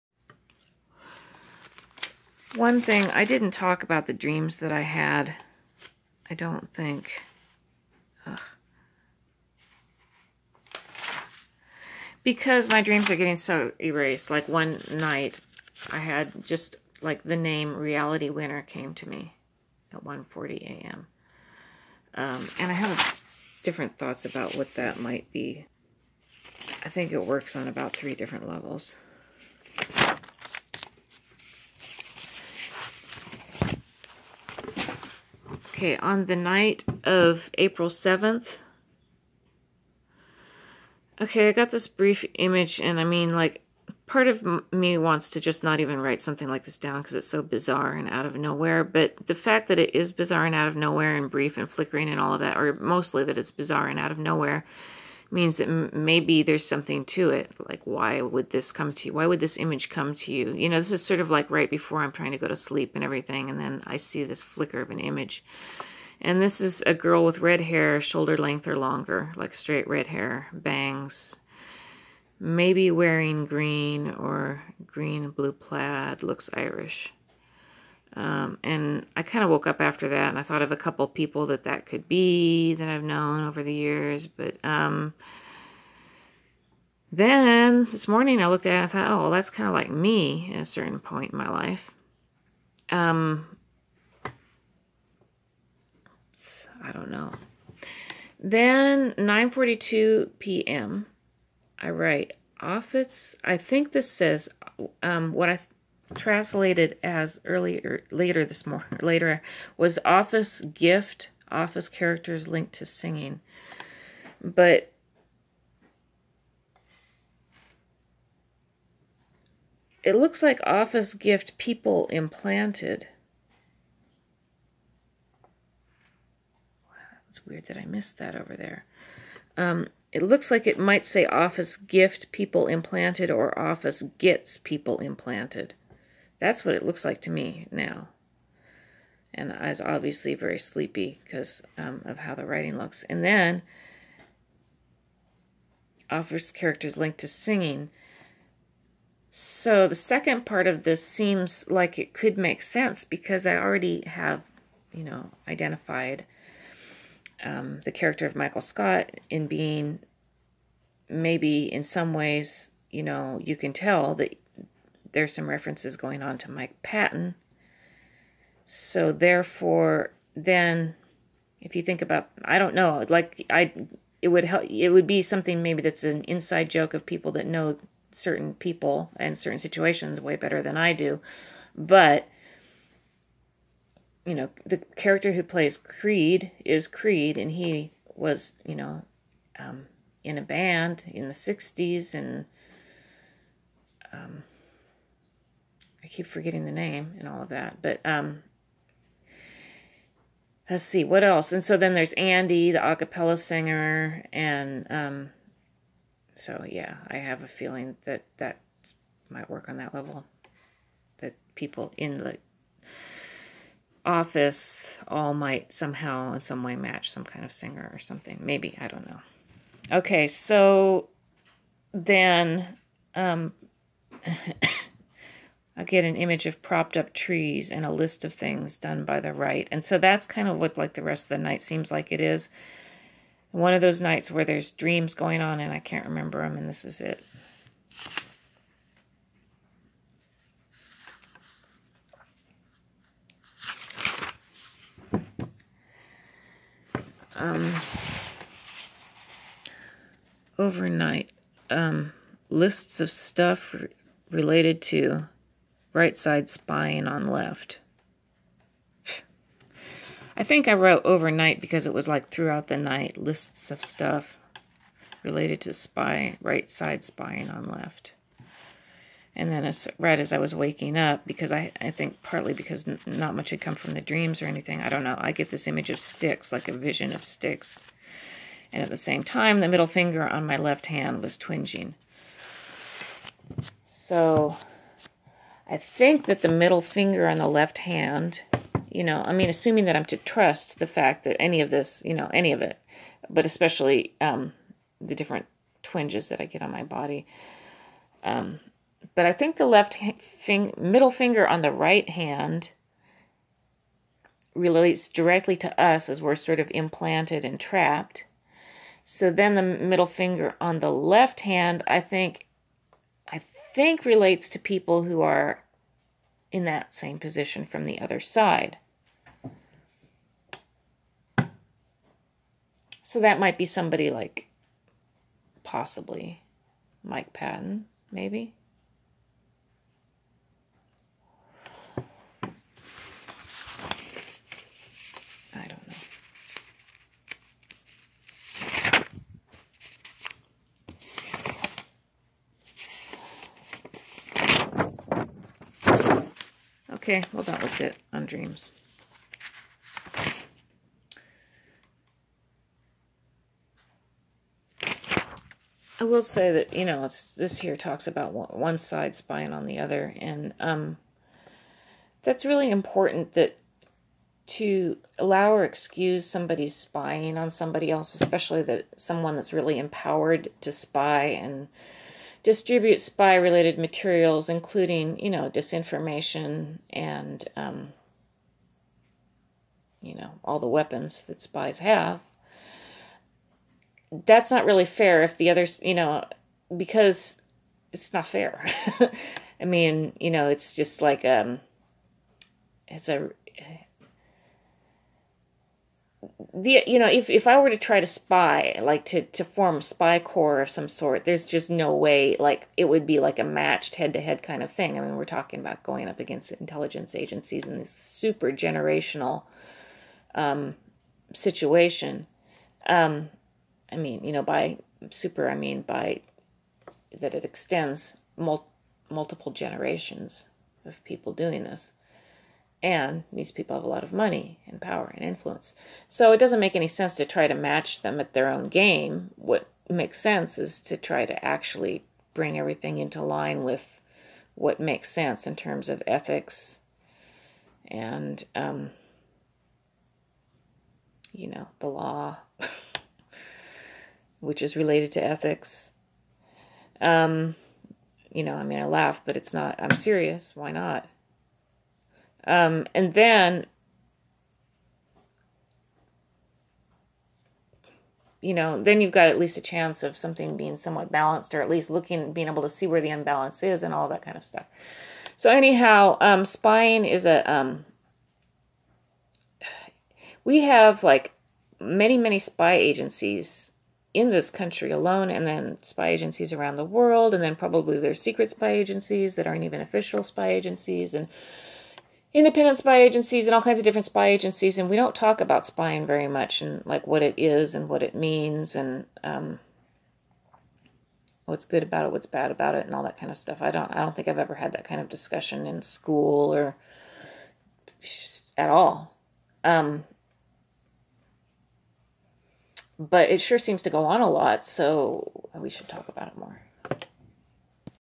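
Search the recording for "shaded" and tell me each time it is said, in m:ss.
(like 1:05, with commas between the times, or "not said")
not said.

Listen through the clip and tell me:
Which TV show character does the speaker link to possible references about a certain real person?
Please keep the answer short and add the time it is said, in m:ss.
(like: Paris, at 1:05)
Michael Scott, at 2:38.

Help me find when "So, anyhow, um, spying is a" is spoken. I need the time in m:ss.
7:45.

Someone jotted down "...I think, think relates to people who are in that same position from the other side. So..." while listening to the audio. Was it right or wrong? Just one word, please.
right.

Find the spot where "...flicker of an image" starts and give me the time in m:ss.
1:04.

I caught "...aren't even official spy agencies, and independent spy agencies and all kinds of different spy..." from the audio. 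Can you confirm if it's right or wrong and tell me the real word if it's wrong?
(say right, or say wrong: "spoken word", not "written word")
right.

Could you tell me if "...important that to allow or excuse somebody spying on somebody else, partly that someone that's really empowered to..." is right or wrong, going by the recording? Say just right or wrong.
wrong.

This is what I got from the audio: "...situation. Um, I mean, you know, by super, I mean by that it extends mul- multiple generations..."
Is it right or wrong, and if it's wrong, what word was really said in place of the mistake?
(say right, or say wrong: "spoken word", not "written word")
right.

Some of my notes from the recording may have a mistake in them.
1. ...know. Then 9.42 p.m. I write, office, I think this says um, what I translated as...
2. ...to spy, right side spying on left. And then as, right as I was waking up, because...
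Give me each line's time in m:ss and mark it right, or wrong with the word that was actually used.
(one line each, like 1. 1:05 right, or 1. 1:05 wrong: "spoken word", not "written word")
1. 1:37 right
2. 4:25 right.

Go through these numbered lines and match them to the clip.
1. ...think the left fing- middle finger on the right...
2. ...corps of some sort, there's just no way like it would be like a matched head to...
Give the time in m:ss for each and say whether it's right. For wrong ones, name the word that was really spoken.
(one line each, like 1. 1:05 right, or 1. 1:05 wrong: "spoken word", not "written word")
1. 4:59 right
2. 6:40 right.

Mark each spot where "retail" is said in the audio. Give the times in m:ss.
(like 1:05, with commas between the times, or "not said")
not said.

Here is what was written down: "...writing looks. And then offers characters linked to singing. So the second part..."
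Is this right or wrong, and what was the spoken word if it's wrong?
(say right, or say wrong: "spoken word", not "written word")
right.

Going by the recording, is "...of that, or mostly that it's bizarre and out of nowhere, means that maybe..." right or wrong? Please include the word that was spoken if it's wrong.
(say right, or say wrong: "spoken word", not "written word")
right.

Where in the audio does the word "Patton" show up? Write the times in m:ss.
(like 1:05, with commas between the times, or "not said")
2:46, 5:27.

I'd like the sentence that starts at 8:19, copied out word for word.
Um, but it sure seems to go on a lot, so we should talk about it more.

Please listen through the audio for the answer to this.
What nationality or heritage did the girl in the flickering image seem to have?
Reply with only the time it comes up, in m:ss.
1:16.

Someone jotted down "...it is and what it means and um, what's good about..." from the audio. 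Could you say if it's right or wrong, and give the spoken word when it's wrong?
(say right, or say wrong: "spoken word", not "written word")
right.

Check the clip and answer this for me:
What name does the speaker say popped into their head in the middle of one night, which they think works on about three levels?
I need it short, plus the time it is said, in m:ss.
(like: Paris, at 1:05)
Reality Winner, at 0:17.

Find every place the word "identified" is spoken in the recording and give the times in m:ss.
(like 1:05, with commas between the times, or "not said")
2:35.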